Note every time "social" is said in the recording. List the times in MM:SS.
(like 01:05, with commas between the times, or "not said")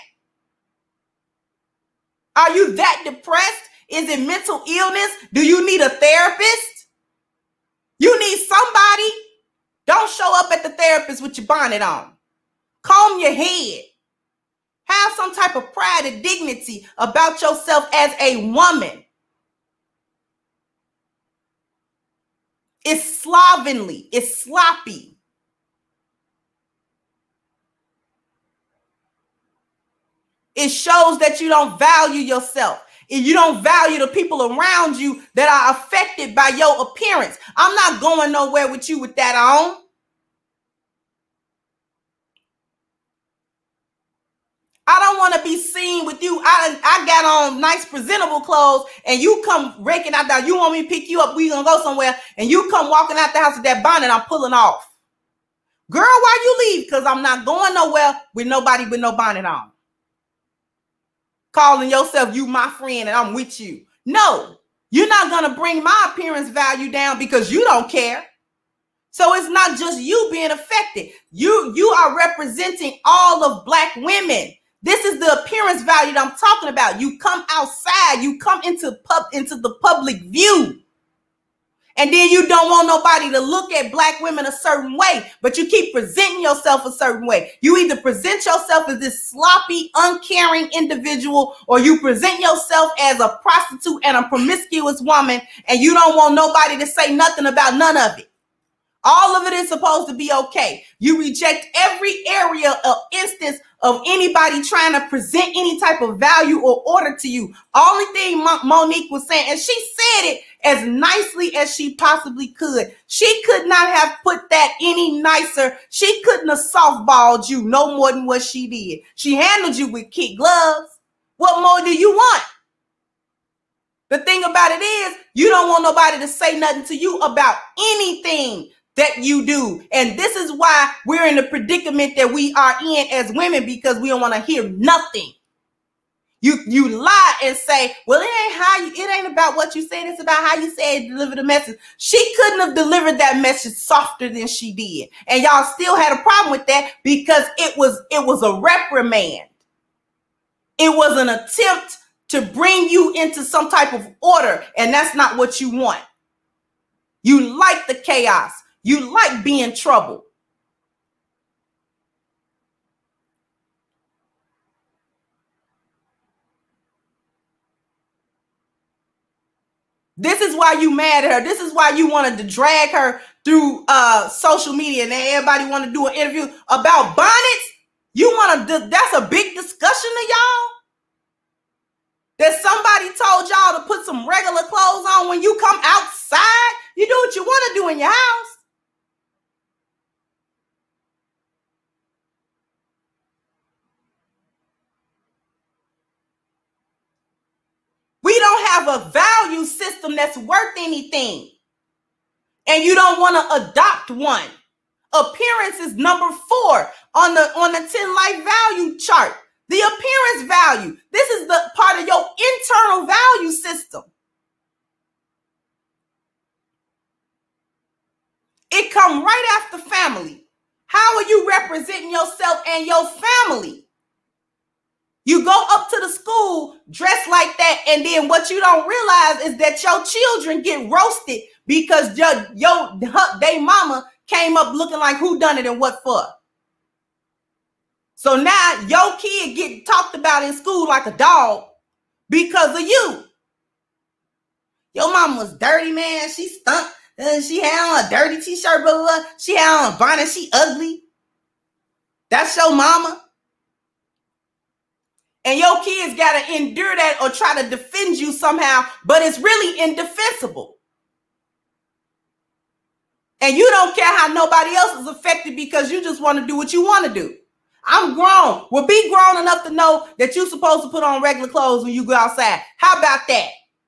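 02:54.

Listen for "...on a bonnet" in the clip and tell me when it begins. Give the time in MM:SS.
04:09.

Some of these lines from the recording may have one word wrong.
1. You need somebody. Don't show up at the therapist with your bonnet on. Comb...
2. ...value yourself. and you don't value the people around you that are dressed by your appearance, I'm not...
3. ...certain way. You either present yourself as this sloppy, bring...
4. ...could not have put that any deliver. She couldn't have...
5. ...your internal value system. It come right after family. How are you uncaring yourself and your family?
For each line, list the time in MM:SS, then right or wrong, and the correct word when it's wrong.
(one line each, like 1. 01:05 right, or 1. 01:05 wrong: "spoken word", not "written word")
1. 00:07 right
2. 00:31 wrong: "affected", not "dressed"
3. 01:26 wrong: "uncaring", not "bring"
4. 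01:53 wrong: "nicer", not "deliver"
5. 03:32 wrong: "representing", not "uncaring".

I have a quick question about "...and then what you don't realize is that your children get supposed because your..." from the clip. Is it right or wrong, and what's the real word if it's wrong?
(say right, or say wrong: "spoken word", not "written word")
wrong: "roasted", not "supposed".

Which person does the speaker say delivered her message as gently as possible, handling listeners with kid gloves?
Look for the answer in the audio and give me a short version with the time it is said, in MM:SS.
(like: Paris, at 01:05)
Monique, at 01:48.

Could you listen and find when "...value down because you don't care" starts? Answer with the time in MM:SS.
01:06.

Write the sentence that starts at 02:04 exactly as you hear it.
The thing about it is, you don't want nobody to say nothing to you about anything that you do.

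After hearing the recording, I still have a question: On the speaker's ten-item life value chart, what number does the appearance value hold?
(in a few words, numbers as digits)
4.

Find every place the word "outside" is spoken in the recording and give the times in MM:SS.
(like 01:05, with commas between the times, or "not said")
01:17, 03:05, 04:32.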